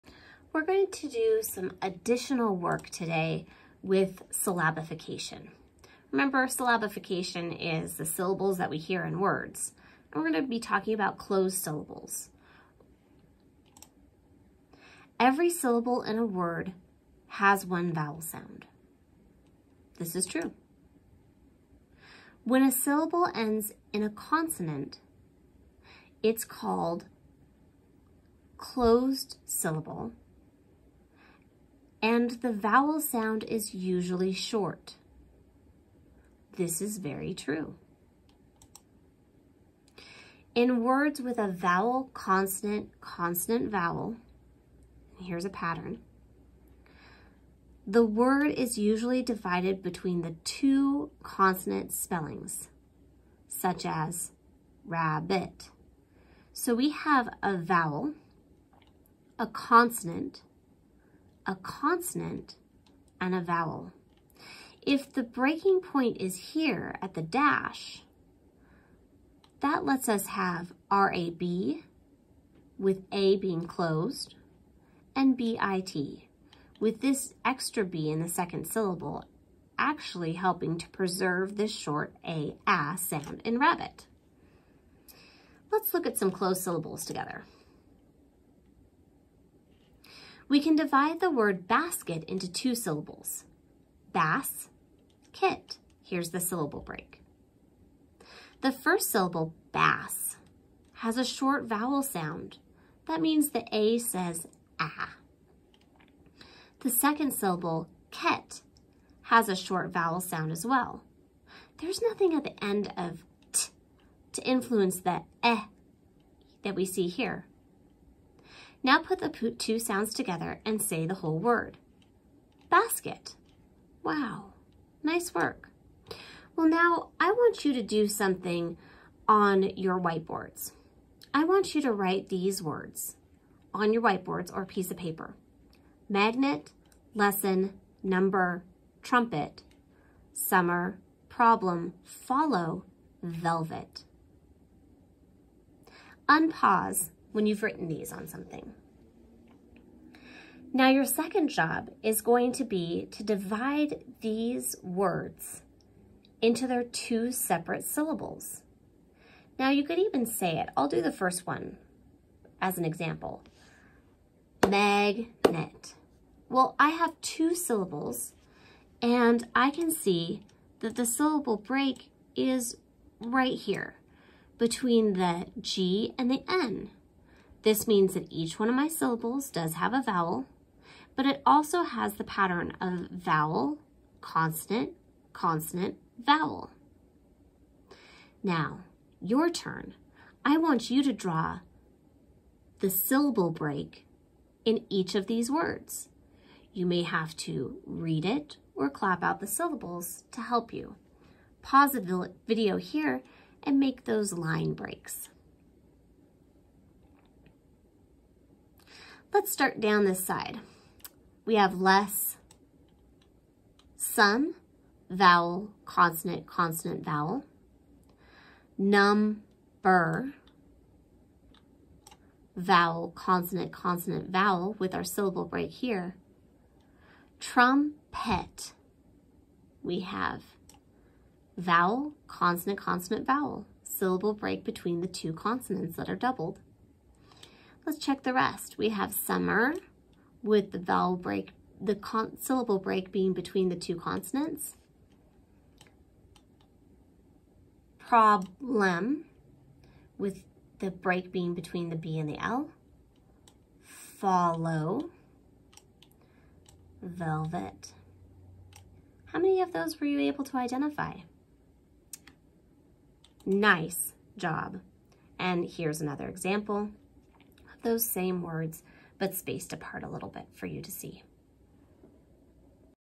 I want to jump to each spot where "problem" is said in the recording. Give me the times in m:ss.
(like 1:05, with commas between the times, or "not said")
2:21, 4:07.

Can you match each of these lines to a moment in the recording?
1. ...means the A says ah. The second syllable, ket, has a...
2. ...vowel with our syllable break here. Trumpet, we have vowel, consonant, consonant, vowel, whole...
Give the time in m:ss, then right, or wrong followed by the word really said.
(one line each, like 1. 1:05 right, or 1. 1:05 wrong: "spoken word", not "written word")
1. 1:43 right
2. 3:44 wrong: "syllable", not "whole".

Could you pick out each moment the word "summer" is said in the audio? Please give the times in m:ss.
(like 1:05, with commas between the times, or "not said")
2:20, 3:59.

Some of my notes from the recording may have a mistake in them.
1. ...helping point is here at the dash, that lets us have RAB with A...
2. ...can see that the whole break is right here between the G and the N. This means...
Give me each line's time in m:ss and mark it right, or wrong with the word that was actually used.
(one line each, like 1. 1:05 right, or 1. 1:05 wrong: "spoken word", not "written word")
1. 1:05 wrong: "breaking", not "helping"
2. 2:49 wrong: "syllable", not "whole".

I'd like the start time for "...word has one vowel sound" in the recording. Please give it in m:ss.
0:16.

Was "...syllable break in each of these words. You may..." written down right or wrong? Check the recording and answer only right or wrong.
right.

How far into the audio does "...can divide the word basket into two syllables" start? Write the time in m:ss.
1:30.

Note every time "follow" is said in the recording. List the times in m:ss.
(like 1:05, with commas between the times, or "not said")
2:22, 4:13.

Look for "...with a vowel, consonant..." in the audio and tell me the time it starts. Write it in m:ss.
0:41.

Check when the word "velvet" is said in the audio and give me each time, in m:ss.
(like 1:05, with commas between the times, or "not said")
2:23, 4:17.